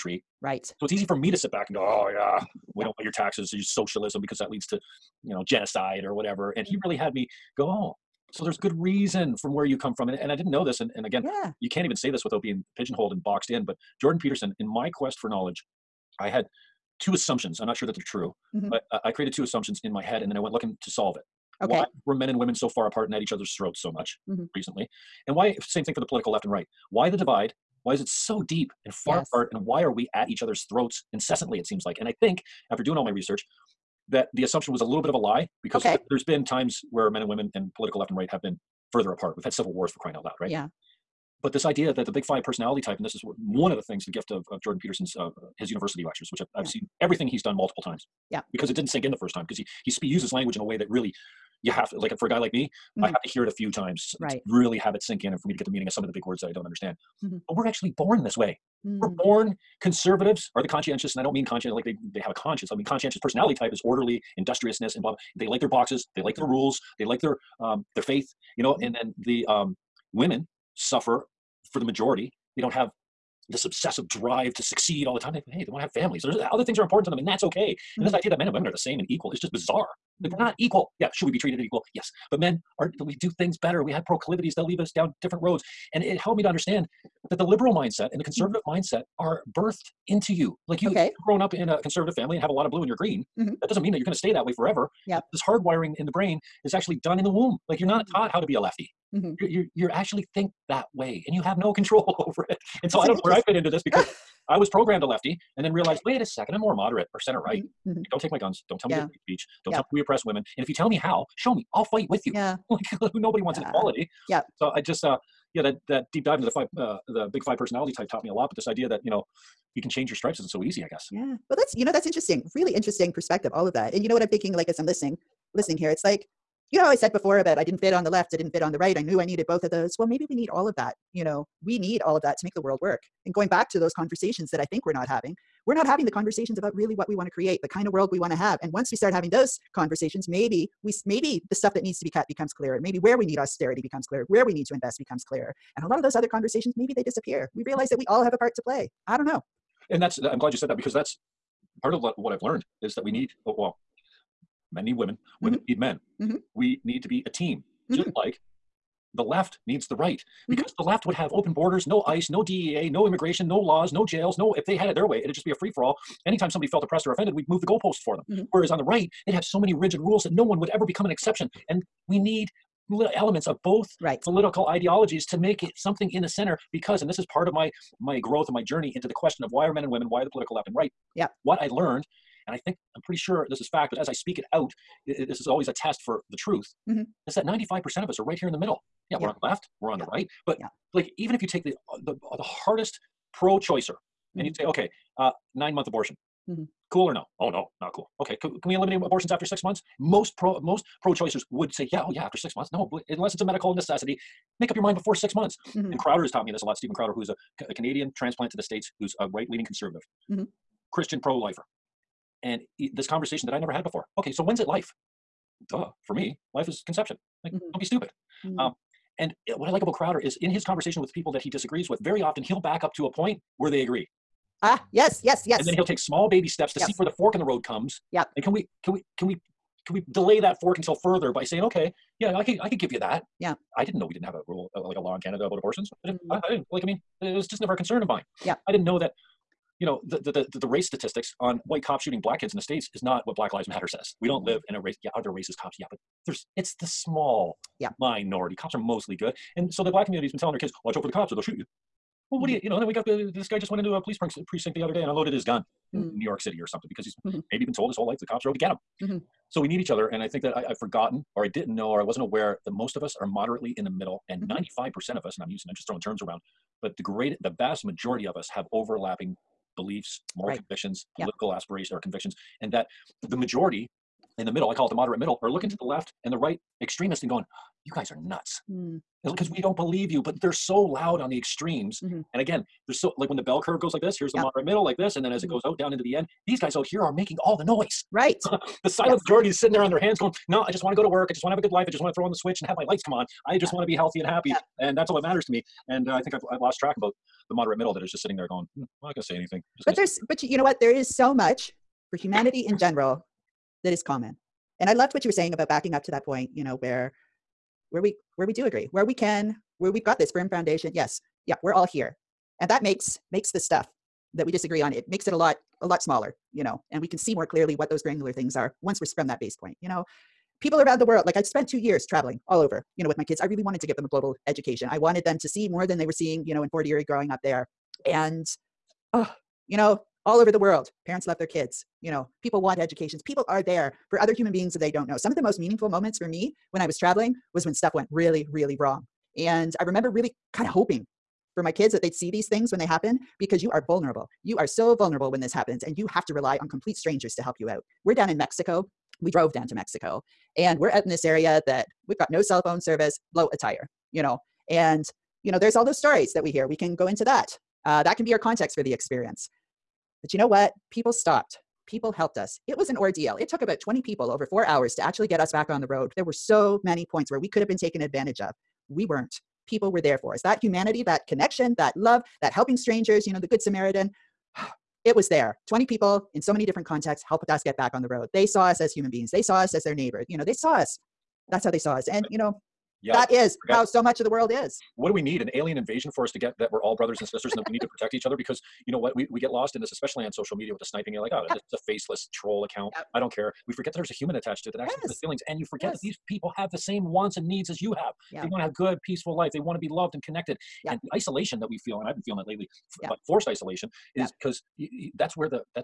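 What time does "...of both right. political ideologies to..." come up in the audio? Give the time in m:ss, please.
2:53.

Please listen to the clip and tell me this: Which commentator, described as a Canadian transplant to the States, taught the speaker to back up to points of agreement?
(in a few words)
Steven Crowder.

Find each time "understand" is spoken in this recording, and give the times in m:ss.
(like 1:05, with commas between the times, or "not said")
0:56, 1:26.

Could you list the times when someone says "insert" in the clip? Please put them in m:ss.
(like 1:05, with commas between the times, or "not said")
not said.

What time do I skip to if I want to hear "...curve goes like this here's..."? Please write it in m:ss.
4:43.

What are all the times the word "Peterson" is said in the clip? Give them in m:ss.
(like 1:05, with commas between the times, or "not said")
0:14, 0:44.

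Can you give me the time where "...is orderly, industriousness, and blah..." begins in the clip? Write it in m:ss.
1:03.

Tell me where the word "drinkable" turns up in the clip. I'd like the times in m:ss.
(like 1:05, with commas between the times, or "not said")
not said.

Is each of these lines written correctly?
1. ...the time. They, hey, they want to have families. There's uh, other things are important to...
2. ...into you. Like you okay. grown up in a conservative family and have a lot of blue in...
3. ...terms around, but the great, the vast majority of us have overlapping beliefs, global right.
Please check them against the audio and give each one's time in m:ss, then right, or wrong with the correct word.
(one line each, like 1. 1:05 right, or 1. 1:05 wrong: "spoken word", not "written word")
1. 1:15 right
2. 1:30 right
3. 4:25 wrong: "moral", not "global".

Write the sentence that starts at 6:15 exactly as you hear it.
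20 people in so many different contexts helped us get back on the road.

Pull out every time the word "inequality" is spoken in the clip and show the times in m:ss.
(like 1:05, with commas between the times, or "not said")
1:53.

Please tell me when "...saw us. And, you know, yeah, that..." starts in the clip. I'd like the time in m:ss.
6:21.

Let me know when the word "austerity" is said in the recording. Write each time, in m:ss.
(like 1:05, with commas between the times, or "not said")
2:23.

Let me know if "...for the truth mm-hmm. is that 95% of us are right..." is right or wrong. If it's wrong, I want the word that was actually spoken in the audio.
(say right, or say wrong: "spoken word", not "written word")
right.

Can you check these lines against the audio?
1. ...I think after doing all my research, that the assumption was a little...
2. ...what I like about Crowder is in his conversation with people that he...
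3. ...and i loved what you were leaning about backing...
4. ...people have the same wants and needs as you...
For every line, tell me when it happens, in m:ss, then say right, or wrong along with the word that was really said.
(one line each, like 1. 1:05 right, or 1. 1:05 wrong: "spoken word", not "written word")
1. 0:32 right
2. 3:39 right
3. 5:04 wrong: "saying", not "leaning"
4. 6:36 right.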